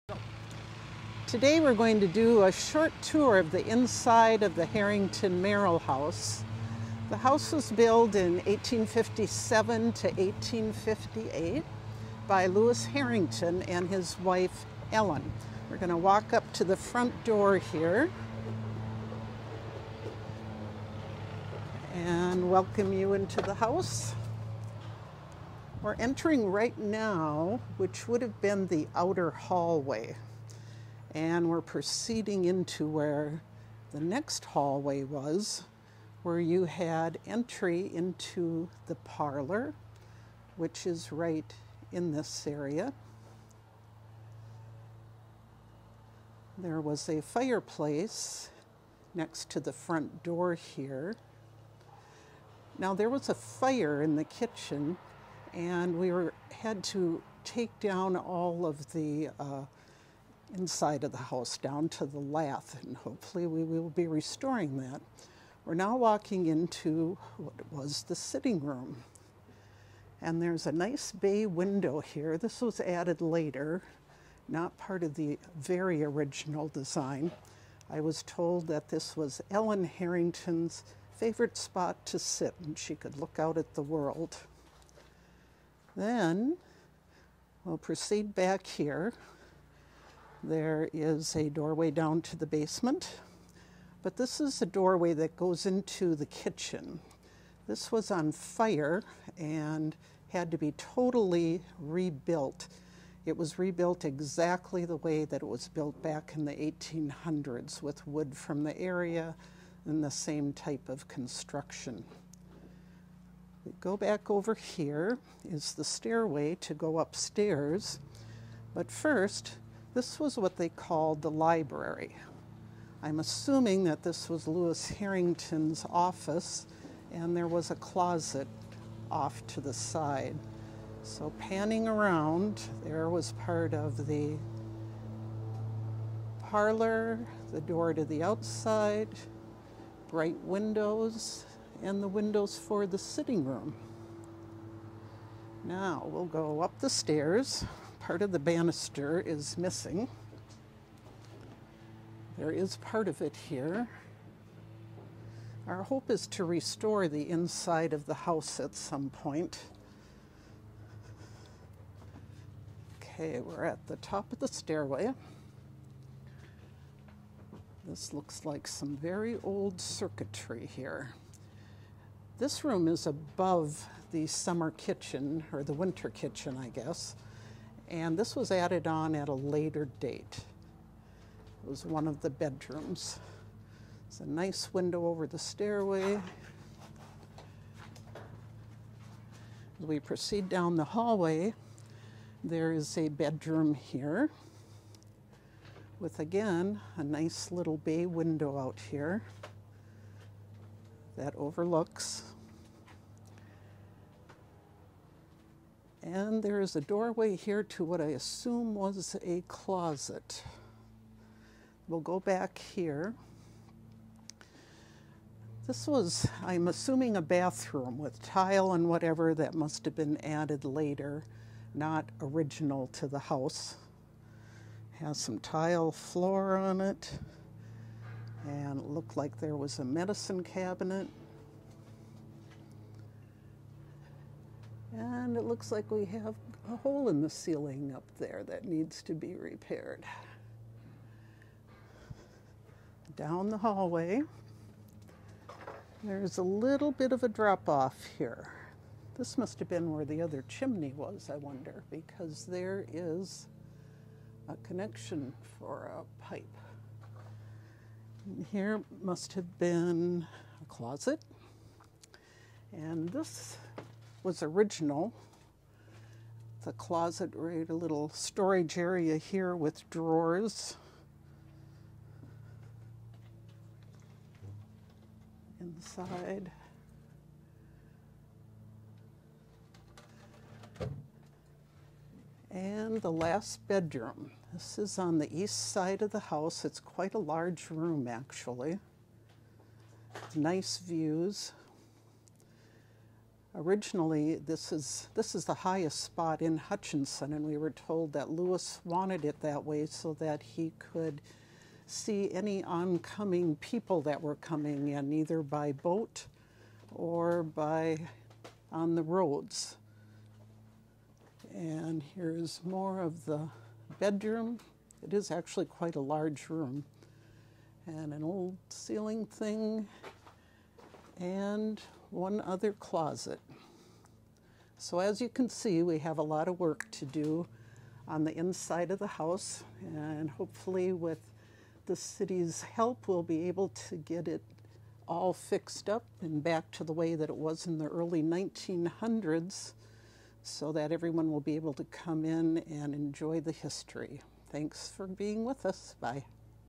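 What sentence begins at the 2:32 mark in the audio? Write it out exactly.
There is part of it here.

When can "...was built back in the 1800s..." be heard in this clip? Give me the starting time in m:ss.
1:45.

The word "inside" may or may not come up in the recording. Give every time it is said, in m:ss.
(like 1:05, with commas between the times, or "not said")
0:03, 1:00, 2:37, 4:35, 5:28.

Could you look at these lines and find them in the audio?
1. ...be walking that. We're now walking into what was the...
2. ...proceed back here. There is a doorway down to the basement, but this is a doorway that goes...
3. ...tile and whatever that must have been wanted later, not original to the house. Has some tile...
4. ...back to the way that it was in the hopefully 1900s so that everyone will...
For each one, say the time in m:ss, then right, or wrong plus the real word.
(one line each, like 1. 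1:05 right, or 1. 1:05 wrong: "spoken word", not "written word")
1. 1:03 wrong: "restoring", not "walking"
2. 1:27 right
3. 3:38 wrong: "added", not "wanted"
4. 5:36 wrong: "early", not "hopefully".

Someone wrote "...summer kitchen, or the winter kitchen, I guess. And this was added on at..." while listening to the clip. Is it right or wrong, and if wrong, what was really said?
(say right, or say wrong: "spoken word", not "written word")
right.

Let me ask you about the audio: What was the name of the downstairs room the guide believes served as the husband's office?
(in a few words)
library.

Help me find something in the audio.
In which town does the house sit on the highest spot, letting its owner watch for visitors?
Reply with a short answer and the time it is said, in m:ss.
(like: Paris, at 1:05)
Hutchinson, at 4:56.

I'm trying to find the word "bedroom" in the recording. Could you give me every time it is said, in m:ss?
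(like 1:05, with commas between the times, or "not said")
3:02, 3:13, 4:43, 5:13.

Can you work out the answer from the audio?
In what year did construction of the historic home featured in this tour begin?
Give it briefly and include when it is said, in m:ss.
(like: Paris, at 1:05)
1857, at 0:08.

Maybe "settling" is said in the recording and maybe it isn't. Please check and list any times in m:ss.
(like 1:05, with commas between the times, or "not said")
not said.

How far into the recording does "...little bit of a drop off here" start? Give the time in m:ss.
4:06.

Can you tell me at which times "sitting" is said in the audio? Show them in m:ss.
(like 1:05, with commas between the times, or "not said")
1:08, 2:22.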